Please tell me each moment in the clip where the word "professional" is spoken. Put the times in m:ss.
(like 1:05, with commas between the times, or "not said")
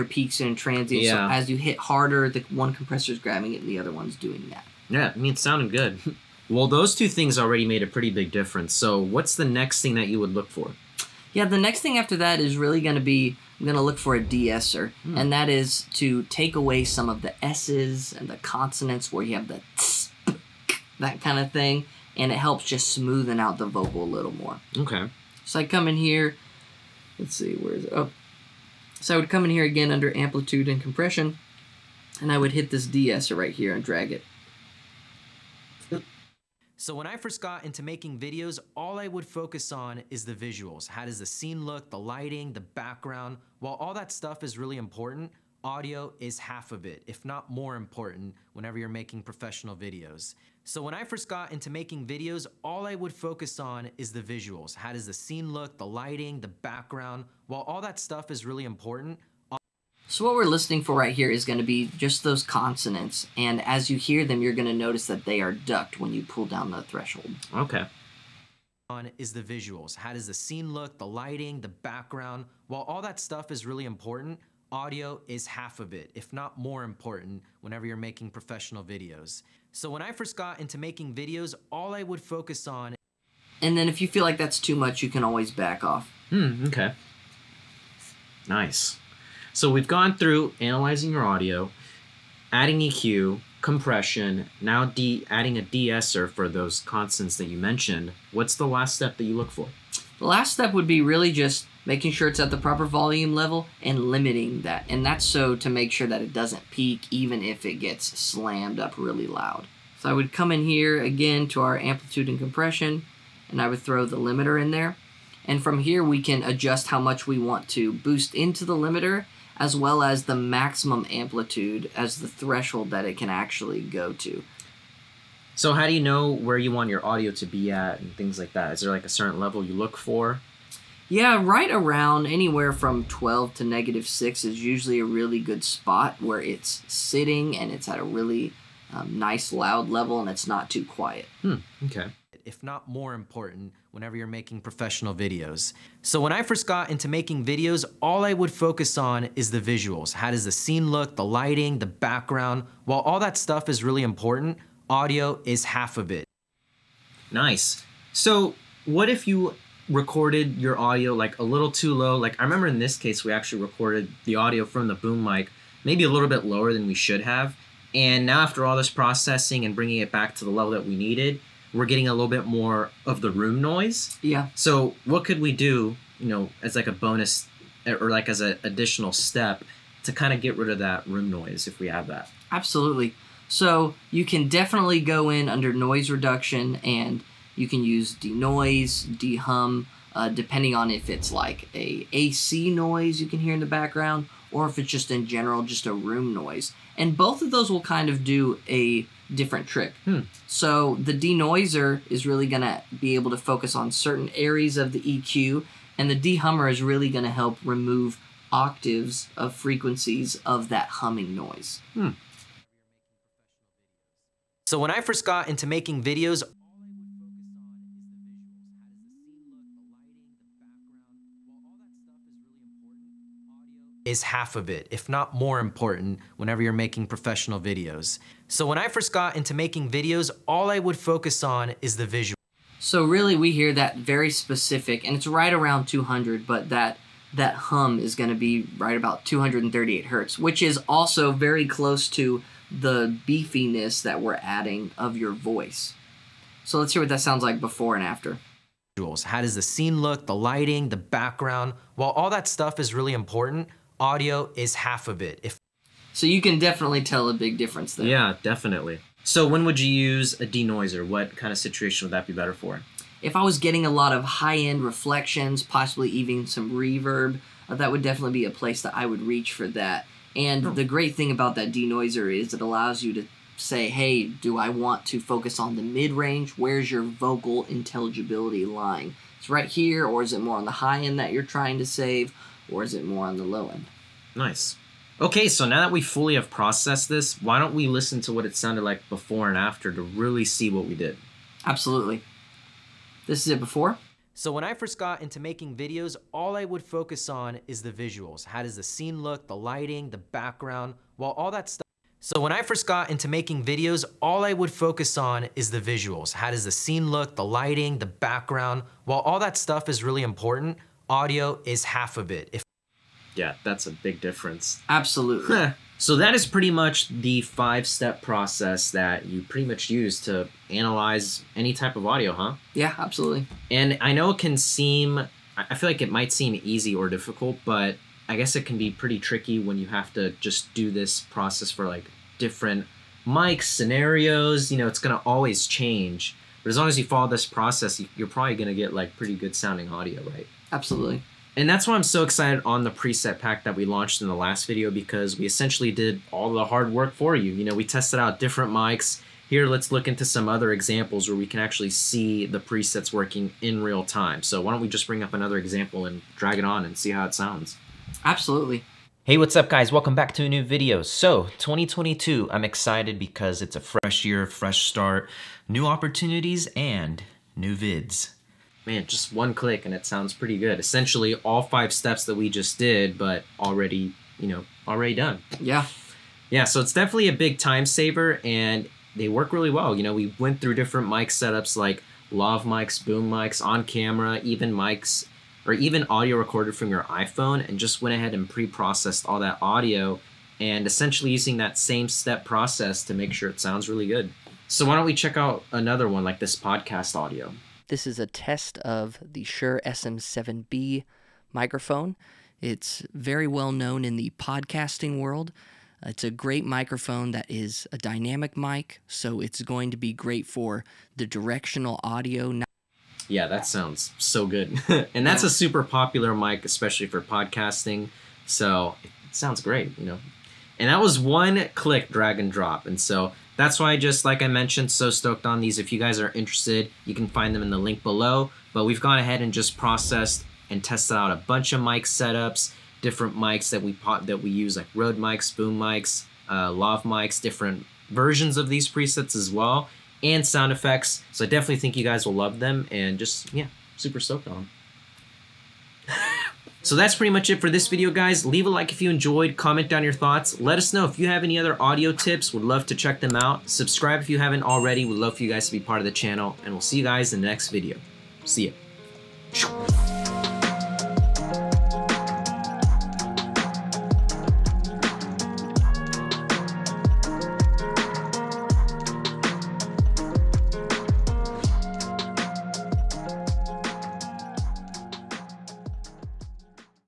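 0:49, 1:18, 2:24, 3:47.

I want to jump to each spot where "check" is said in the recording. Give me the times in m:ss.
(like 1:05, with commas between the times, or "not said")
6:35, 7:32.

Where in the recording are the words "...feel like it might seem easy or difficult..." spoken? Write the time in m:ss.
5:25.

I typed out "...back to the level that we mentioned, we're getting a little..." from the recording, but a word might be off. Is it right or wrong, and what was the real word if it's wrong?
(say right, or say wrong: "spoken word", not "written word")
wrong: "needed", not "mentioned".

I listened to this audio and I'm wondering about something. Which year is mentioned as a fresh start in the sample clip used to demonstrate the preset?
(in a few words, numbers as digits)
2022.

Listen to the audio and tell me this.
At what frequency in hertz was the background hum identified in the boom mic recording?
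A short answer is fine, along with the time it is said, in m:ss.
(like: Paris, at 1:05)
238 hertz, at 3:59.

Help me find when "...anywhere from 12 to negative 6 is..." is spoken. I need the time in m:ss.
2:12.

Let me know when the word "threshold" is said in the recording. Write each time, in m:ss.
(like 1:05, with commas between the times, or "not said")
1:06, 2:02.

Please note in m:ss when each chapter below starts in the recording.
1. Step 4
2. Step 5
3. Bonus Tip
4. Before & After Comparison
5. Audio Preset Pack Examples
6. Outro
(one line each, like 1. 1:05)
1. 0:06
2. 1:29
3. 2:37
4. 4:44
5. 5:41
6. 7:25.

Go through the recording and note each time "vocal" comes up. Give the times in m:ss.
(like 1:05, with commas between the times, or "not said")
0:23, 4:37.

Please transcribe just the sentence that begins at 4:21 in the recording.
What kind of situation would that be better for?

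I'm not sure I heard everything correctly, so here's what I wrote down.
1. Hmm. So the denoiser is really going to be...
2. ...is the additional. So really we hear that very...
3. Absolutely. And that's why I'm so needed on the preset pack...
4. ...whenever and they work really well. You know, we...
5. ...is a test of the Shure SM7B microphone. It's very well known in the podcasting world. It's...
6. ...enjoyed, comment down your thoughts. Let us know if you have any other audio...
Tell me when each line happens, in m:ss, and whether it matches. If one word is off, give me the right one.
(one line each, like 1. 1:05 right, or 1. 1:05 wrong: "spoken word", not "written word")
1. 3:20 right
2. 3:51 wrong: "visual", not "additional"
3. 5:40 wrong: "excited", not "needed"
4. 6:17 wrong: "saver", not "whenever"
5. 6:38 right
6. 7:29 right.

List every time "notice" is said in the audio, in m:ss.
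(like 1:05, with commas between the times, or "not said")
1:04.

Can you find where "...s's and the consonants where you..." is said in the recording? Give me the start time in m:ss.
0:17.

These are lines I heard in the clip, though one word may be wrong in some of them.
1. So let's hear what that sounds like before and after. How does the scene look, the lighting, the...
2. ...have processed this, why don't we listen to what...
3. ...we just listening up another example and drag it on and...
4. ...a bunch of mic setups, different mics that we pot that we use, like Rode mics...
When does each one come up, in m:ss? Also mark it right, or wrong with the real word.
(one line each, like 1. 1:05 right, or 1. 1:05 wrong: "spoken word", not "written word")
1. 4:06 right
2. 4:46 right
3. 5:54 wrong: "bring", not "listening"
4. 7:11 right.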